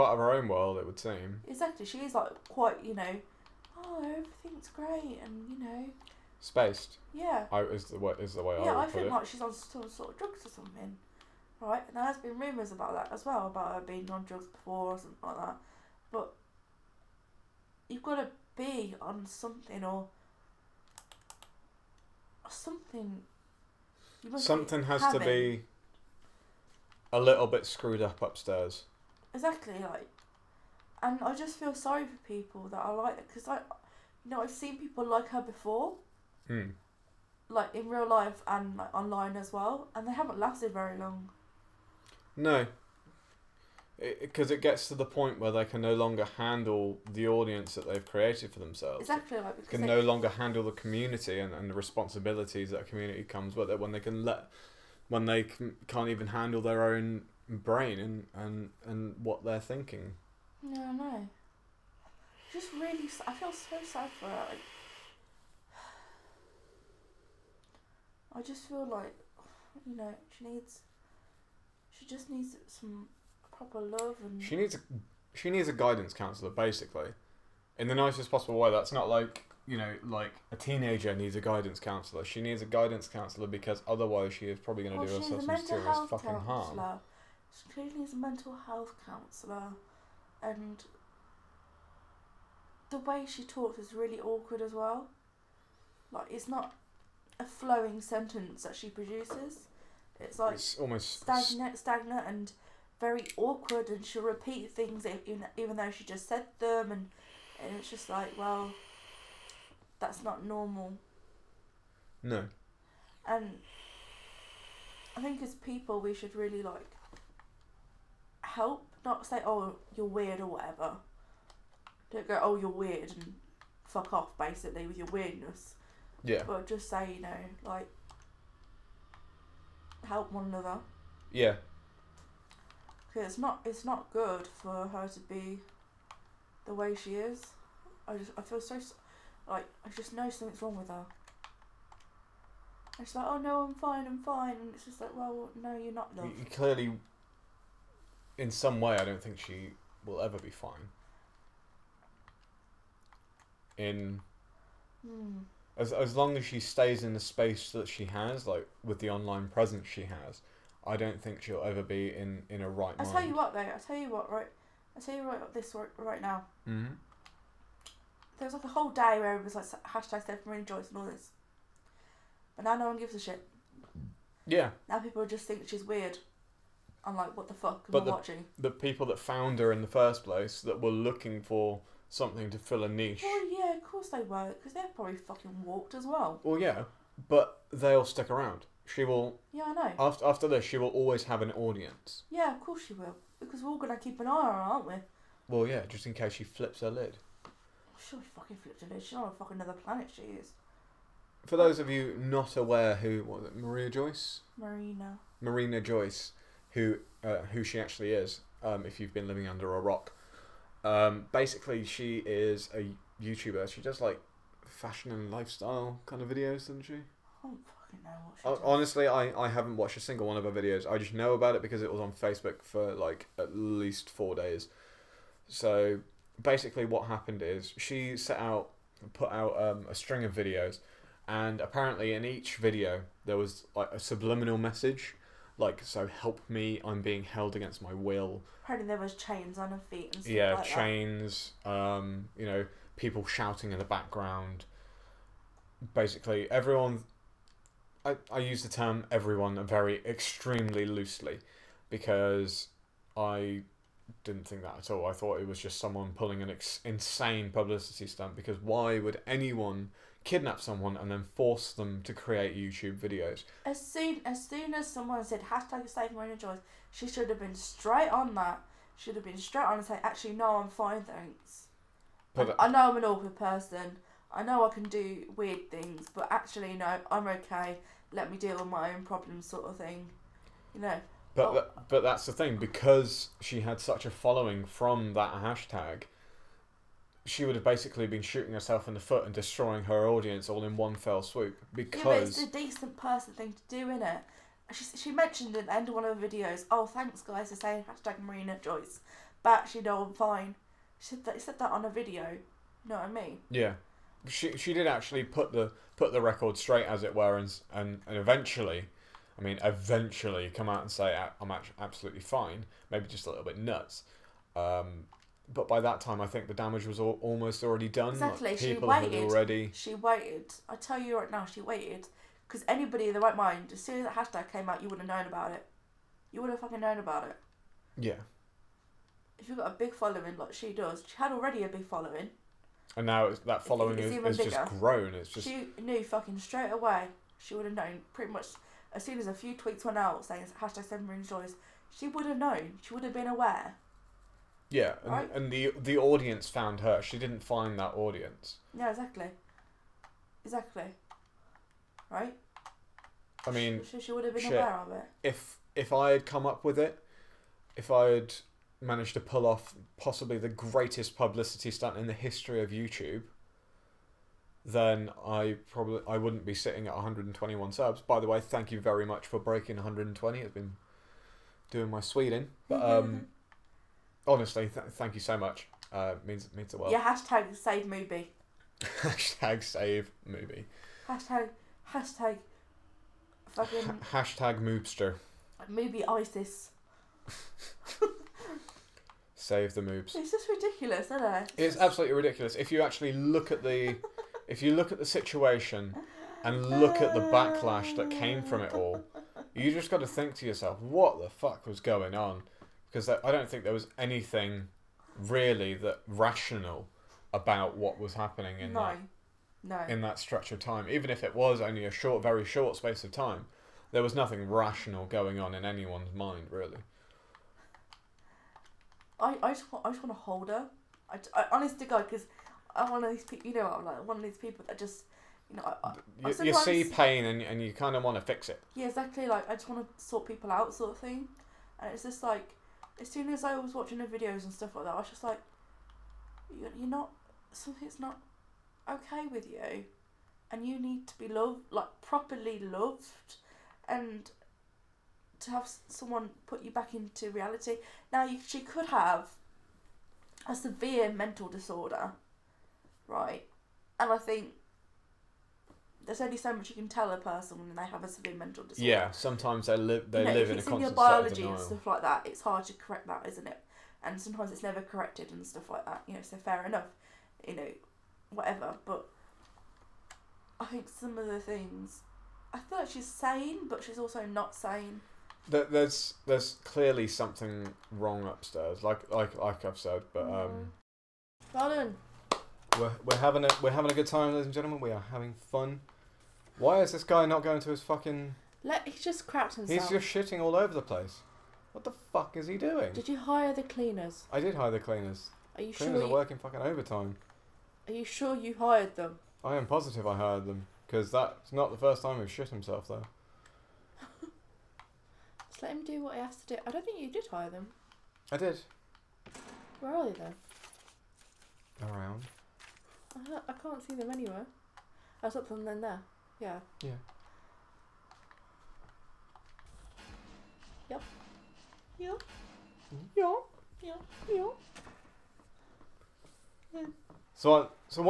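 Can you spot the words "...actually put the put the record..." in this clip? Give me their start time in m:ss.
5:04.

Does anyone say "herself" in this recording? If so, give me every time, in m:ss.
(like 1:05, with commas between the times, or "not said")
1:25, 4:48.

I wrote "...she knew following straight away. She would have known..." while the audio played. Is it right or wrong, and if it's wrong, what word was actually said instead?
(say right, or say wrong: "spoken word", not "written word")
wrong: "fucking", not "following".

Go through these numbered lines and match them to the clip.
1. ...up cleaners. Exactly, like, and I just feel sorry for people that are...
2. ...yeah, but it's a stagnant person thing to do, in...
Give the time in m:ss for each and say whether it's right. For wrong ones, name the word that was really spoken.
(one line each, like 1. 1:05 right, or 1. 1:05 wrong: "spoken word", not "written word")
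1. 0:28 wrong: "upstairs", not "cleaners"
2. 4:52 wrong: "decent", not "stagnant".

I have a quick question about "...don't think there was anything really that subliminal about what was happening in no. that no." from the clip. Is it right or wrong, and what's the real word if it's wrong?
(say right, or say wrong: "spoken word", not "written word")
wrong: "rational", not "subliminal".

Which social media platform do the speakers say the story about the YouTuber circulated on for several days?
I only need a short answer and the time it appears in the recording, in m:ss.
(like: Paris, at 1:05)
Facebook, at 3:42.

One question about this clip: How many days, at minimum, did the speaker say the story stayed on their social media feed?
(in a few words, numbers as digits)
4.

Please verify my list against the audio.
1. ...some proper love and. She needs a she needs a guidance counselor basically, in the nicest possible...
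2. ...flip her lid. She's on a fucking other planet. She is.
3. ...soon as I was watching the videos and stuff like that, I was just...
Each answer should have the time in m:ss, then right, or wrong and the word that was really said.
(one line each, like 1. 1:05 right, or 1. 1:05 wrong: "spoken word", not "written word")
1. 1:12 right
2. 3:18 right
3. 7:13 right.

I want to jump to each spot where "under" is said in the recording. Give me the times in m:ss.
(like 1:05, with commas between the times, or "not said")
3:29.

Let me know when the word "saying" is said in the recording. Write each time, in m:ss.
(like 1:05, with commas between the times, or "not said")
4:57, 5:40.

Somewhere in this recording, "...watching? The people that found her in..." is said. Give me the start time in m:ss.
2:58.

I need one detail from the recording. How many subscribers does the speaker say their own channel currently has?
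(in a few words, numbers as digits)
121.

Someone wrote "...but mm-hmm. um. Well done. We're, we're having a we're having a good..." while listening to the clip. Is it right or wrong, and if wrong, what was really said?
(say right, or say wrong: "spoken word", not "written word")
right.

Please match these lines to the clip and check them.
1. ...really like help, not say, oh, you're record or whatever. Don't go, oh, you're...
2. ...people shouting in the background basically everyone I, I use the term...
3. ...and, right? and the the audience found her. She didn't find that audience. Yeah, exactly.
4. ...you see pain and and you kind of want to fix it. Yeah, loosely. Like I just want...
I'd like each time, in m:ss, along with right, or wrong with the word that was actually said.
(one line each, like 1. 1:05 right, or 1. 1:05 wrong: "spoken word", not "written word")
1. 1:56 wrong: "weird", not "record"
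2. 4:02 right
3. 5:45 right
4. 7:06 wrong: "exactly", not "loosely".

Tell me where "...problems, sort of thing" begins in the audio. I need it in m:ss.
4:39.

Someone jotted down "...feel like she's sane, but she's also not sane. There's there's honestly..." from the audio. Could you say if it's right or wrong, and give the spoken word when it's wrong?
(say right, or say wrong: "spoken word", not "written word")
wrong: "clearly", not "honestly".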